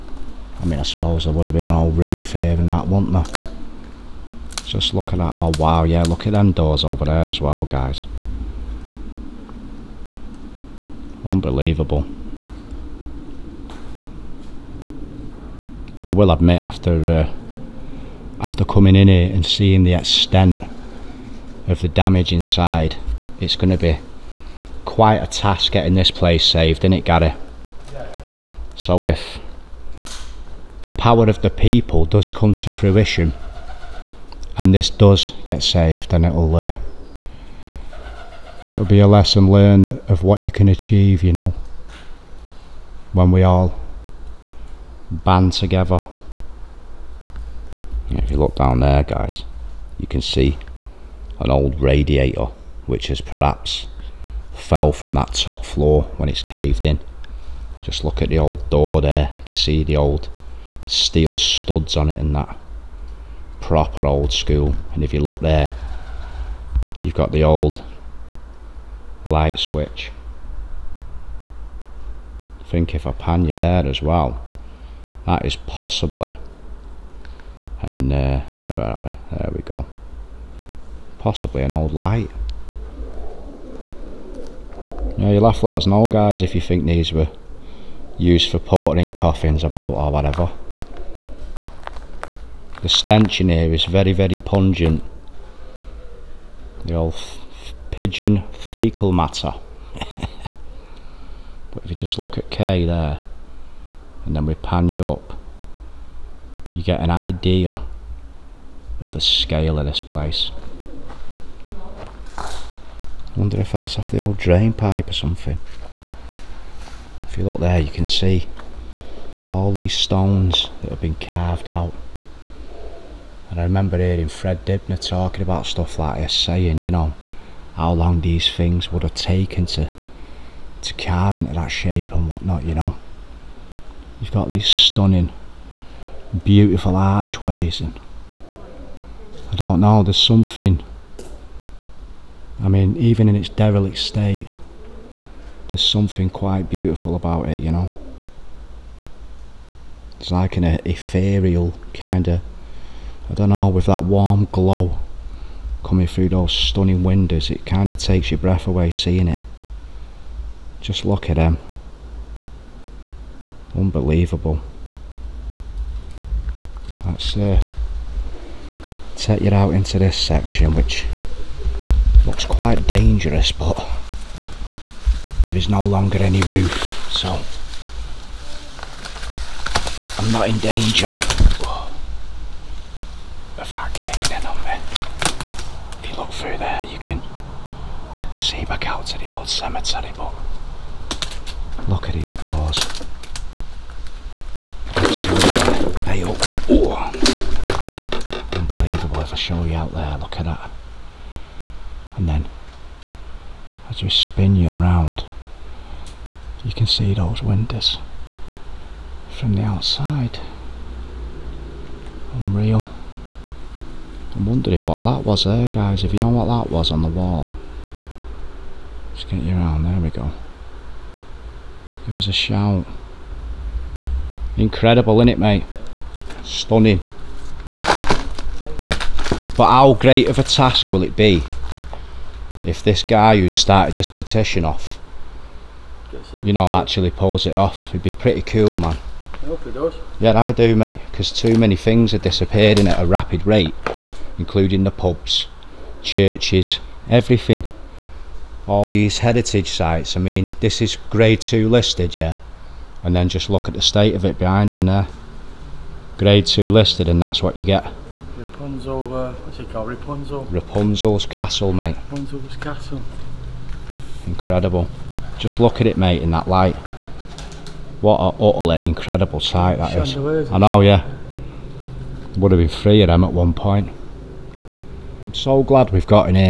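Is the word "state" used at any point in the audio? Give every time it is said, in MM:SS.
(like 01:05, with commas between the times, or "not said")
02:23, 04:13.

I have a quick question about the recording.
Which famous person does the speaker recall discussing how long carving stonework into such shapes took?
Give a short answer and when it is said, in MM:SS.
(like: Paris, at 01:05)
Fred Dibnah, at 02:04.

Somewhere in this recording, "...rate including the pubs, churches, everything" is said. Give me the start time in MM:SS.
04:03.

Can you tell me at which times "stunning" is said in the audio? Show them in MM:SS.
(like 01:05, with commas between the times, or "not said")
02:14, 02:36, 03:46.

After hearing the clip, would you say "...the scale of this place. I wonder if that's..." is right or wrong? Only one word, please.
right.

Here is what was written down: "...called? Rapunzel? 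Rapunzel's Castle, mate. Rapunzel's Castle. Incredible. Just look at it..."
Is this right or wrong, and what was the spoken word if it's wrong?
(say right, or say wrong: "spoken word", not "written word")
right.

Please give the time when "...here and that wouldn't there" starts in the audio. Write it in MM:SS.
00:02.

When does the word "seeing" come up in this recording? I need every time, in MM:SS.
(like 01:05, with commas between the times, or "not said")
00:19, 02:38.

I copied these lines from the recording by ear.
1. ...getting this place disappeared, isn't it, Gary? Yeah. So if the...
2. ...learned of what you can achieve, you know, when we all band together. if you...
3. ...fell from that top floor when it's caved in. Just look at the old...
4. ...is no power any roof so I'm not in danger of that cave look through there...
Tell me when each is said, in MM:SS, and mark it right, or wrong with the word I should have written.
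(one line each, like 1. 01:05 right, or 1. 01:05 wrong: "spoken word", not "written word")
1. 00:25 wrong: "saved", not "disappeared"
2. 00:39 right
3. 00:54 right
4. 02:55 wrong: "longer", not "power".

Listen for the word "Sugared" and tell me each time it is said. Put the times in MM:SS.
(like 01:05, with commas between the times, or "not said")
not said.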